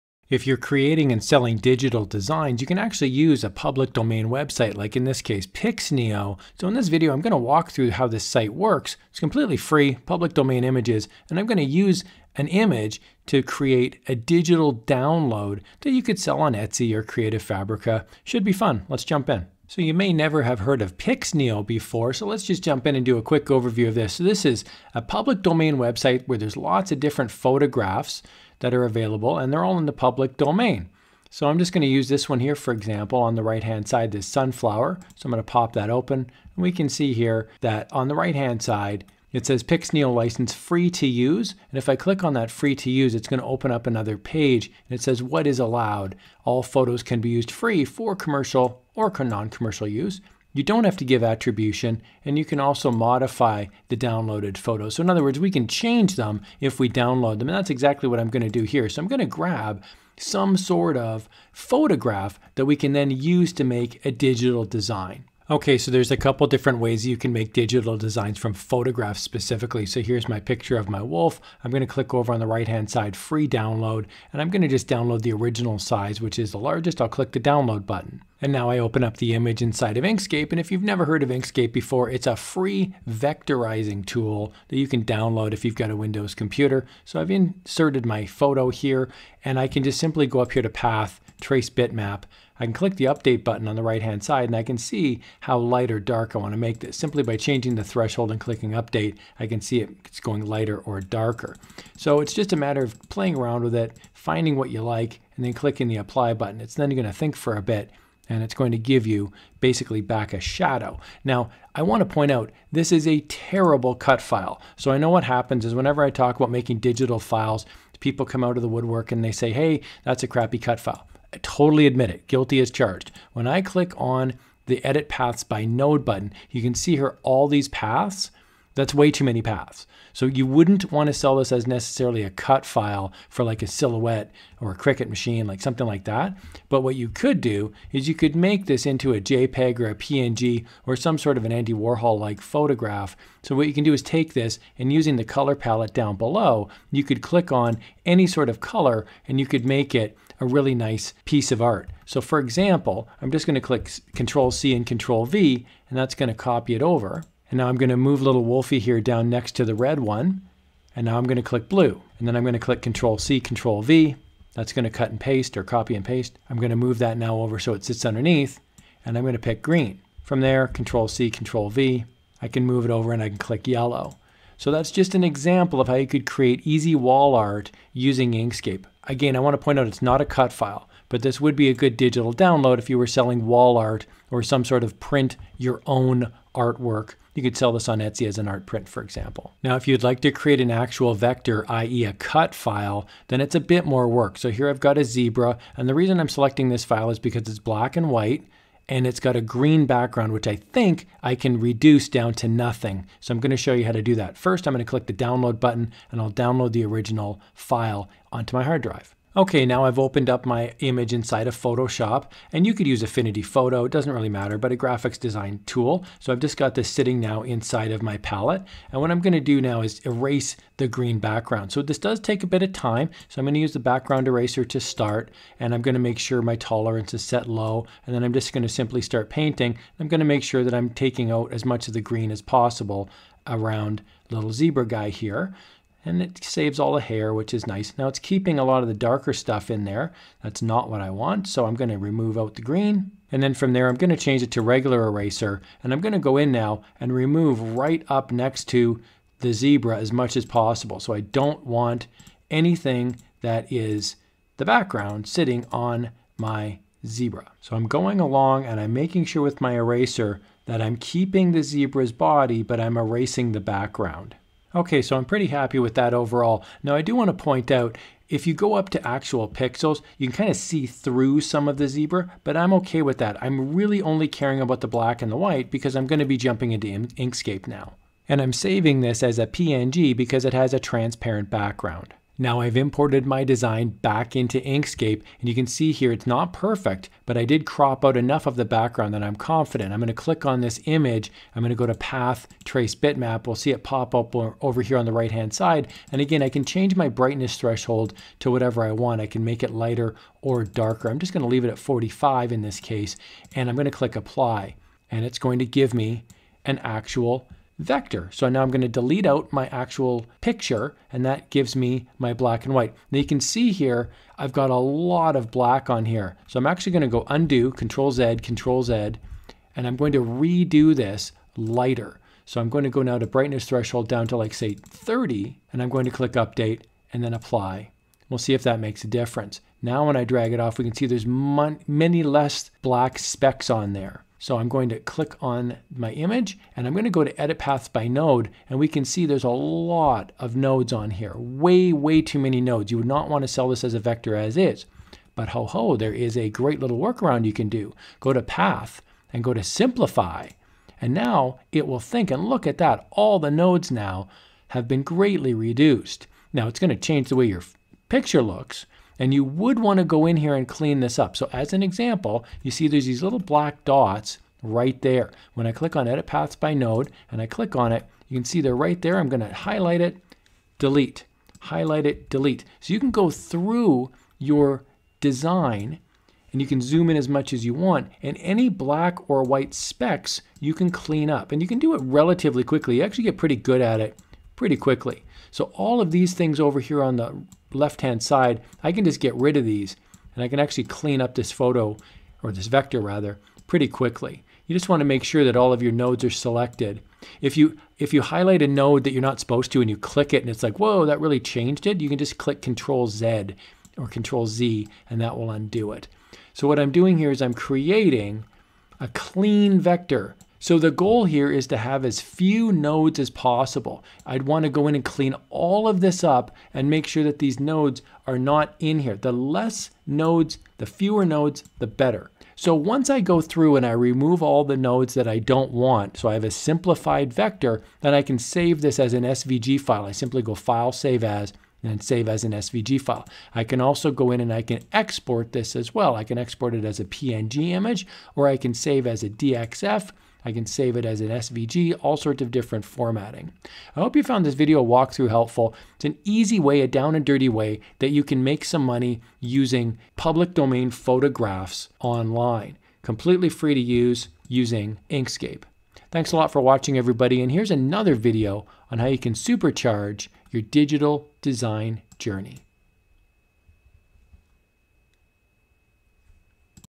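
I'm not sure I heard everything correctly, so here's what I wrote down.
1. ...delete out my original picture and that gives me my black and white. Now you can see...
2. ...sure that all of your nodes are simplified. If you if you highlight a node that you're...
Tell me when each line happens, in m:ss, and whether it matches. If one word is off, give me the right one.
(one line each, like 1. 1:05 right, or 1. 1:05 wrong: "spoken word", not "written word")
1. 5:08 wrong: "actual", not "original"
2. 6:35 wrong: "selected", not "simplified".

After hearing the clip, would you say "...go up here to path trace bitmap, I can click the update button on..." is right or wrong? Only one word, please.
right.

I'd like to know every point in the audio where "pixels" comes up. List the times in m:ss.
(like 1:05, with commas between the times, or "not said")
4:29.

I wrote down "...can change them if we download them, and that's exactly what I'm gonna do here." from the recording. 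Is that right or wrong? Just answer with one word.
right.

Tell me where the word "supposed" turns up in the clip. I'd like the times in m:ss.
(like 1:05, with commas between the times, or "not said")
6:39.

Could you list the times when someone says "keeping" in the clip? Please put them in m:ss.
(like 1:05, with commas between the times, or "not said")
3:58, 4:20.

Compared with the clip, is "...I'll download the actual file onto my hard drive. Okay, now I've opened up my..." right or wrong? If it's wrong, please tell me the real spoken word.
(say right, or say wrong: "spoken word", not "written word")
wrong: "original", not "actual".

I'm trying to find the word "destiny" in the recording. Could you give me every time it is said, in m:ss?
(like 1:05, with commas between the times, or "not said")
not said.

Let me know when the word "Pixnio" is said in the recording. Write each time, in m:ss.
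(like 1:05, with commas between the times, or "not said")
0:05, 0:20, 0:39.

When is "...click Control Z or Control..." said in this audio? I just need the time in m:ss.
6:42.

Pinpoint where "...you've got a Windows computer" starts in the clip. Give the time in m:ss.
1:25.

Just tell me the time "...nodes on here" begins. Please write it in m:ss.
5:40.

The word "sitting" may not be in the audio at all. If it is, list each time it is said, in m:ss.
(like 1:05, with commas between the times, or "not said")
3:36, 4:15.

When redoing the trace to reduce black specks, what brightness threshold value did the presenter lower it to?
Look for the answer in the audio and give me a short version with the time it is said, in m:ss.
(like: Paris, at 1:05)
30, at 5:24.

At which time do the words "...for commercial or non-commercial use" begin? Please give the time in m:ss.
0:47.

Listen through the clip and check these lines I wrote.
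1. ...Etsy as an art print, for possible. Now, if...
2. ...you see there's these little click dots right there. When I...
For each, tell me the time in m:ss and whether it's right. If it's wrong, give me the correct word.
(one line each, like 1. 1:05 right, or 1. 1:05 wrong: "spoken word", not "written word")
1. 3:07 wrong: "example", not "possible"
2. 6:02 wrong: "black", not "click".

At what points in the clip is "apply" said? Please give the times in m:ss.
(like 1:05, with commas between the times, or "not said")
1:45, 5:04, 5:27.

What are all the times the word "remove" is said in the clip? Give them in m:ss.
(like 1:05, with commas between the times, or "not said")
4:01, 4:07, 7:03.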